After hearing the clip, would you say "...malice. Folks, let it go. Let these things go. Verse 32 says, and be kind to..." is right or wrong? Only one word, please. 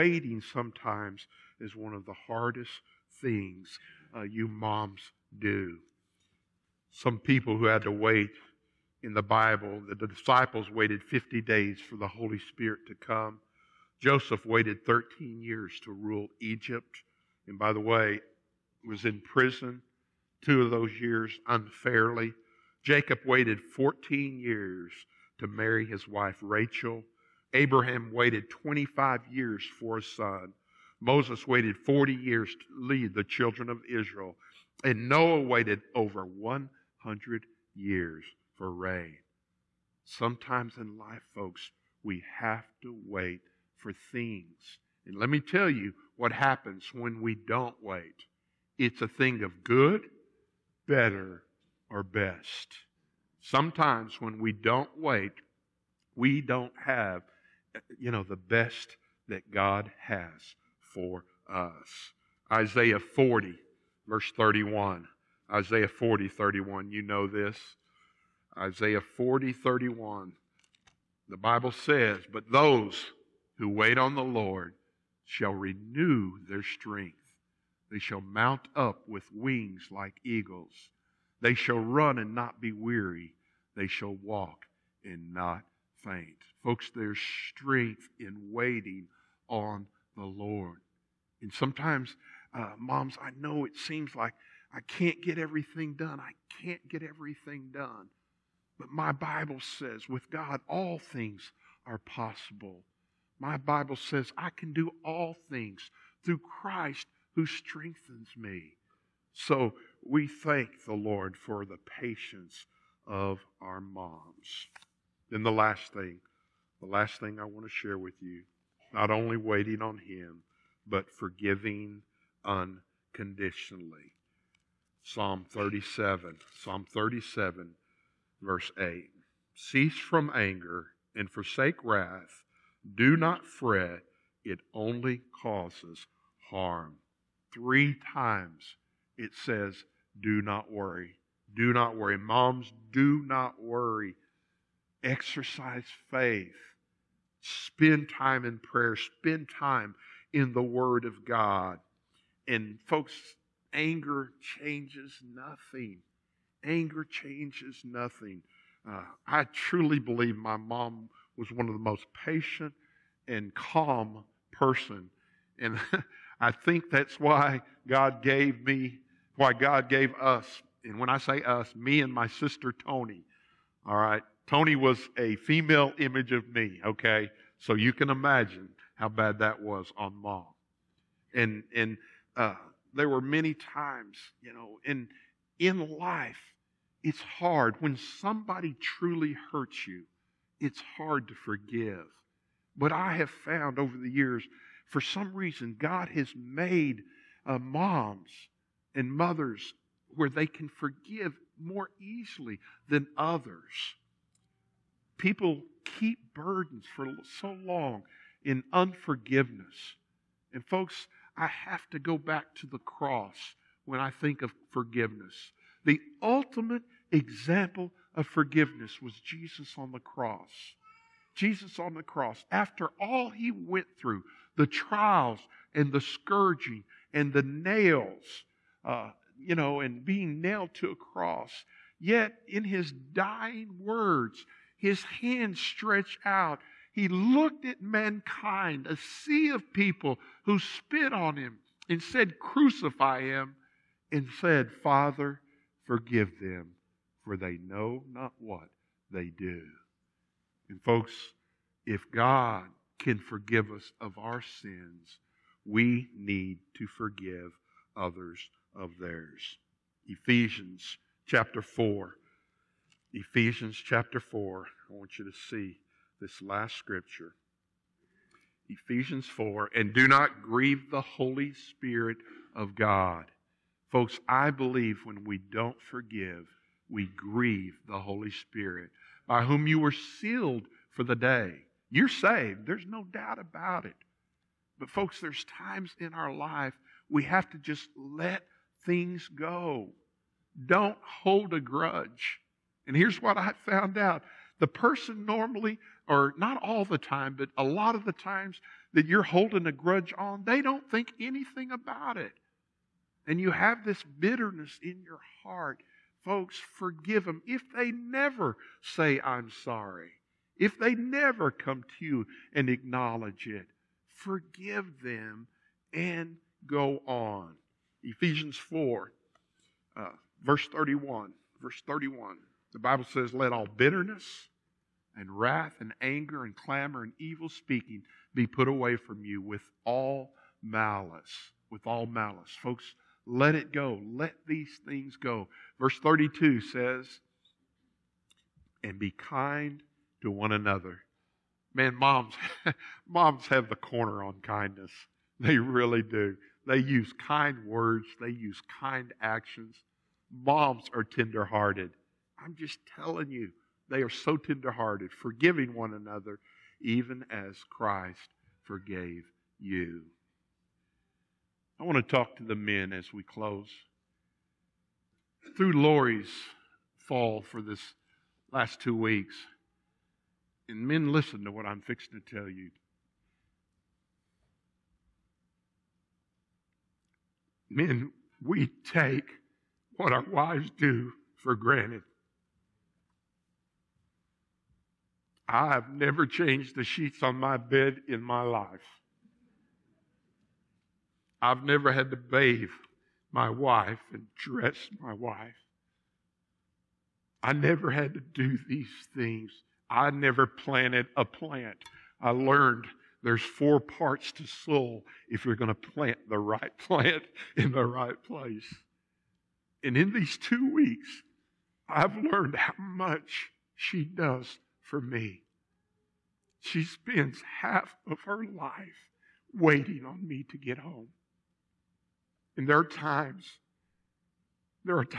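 right.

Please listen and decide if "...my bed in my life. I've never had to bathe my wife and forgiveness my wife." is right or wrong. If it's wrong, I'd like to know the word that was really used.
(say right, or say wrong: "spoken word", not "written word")
wrong: "dress", not "forgiveness".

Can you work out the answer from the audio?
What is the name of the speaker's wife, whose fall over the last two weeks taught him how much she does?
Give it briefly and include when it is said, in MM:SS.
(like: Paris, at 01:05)
Lori, at 06:05.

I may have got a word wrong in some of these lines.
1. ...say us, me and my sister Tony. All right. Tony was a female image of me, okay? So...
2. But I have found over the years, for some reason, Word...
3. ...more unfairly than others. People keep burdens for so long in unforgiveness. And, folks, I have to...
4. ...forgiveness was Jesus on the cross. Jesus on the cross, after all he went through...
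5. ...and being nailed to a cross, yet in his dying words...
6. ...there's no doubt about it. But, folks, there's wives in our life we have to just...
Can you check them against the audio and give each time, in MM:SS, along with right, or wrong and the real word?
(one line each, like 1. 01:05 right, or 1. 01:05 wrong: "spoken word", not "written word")
1. 02:51 right
2. 03:12 wrong: "God", not "Word"
3. 03:21 wrong: "easily", not "unfairly"
4. 03:38 right
5. 03:49 right
6. 04:42 wrong: "times", not "wives".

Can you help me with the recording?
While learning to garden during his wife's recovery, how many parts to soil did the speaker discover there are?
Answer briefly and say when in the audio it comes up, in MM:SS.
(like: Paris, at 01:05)
4, at 06:43.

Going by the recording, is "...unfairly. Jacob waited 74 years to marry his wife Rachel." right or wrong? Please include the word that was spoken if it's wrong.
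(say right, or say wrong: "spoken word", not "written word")
wrong: "14", not "74".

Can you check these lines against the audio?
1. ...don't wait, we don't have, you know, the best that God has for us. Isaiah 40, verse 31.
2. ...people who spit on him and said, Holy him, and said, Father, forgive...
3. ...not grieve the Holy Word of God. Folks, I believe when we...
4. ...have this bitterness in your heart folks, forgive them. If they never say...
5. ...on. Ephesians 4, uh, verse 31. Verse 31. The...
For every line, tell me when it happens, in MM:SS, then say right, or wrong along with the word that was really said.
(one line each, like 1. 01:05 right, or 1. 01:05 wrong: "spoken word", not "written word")
1. 00:54 right
2. 03:59 wrong: "Crucify", not "Holy"
3. 04:30 wrong: "Spirit", not "Word"
4. 05:03 right
5. 05:17 right.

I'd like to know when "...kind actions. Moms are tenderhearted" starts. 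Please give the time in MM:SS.
05:48.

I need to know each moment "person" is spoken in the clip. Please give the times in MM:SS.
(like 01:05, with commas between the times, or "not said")
02:44, 04:54.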